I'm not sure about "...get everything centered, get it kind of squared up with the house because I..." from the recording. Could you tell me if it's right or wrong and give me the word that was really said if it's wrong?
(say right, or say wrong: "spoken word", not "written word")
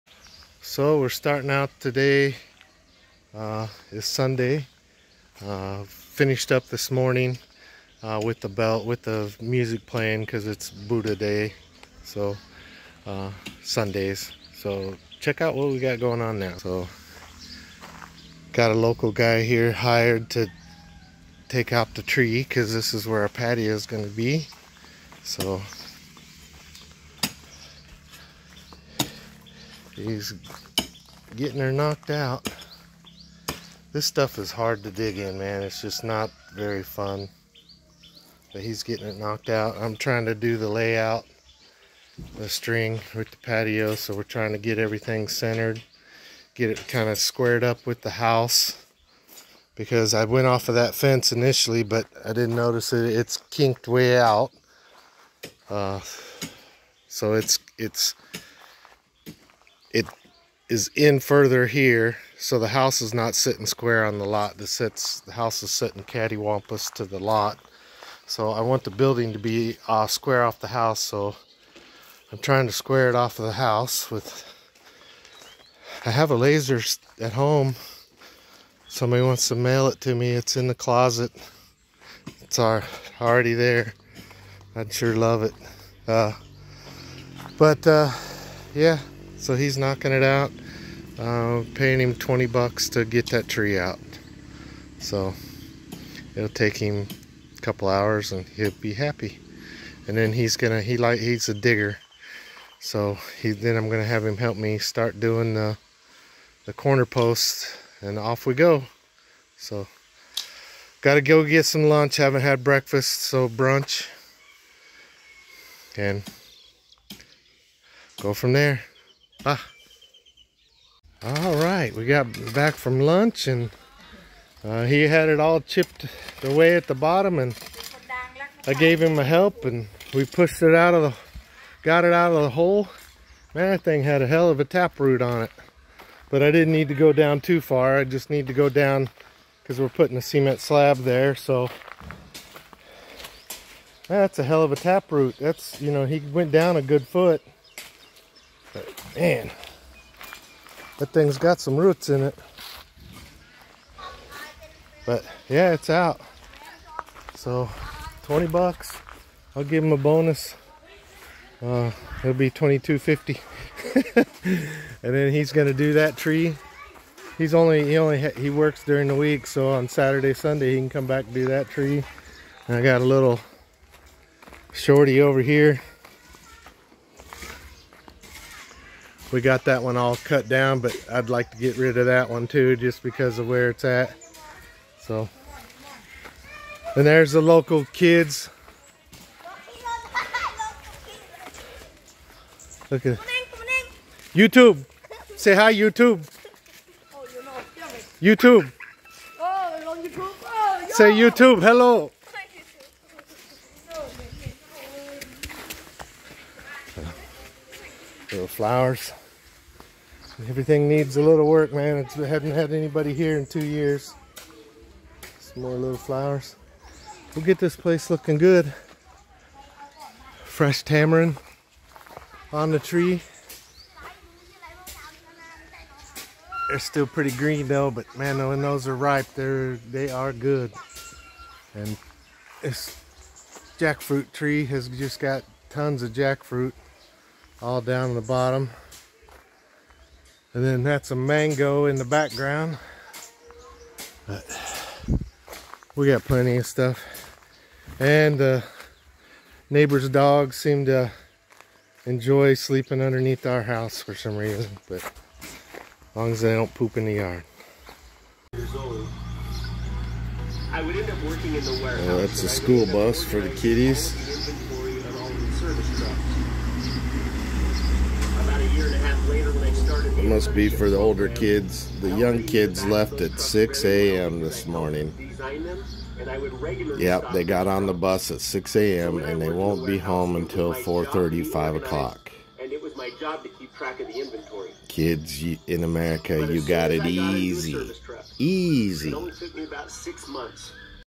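right.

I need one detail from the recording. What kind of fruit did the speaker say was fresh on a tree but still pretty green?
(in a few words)
Tamarind.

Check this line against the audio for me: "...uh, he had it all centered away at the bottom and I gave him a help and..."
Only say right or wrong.
wrong.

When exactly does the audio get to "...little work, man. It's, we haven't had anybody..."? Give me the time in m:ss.
3:31.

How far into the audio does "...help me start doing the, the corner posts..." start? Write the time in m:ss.
1:44.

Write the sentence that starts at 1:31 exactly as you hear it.
Uh, paying him 20 bucks to get that tree out.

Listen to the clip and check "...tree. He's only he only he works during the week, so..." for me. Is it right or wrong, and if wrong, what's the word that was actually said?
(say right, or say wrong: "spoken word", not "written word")
right.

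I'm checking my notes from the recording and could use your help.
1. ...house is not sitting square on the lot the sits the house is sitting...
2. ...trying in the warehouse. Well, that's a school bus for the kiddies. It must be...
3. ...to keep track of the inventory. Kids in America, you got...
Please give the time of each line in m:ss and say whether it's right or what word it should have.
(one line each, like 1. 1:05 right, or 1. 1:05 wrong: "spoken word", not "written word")
1. 1:02 right
2. 4:21 wrong: "working", not "trying"
3. 4:43 right.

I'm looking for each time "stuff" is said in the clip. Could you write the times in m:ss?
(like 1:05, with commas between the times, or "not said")
0:34, 4:06.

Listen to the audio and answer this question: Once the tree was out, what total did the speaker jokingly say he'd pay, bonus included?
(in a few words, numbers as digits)
22.50.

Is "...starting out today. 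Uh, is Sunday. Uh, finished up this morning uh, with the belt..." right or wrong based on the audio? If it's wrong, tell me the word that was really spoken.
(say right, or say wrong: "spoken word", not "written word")
right.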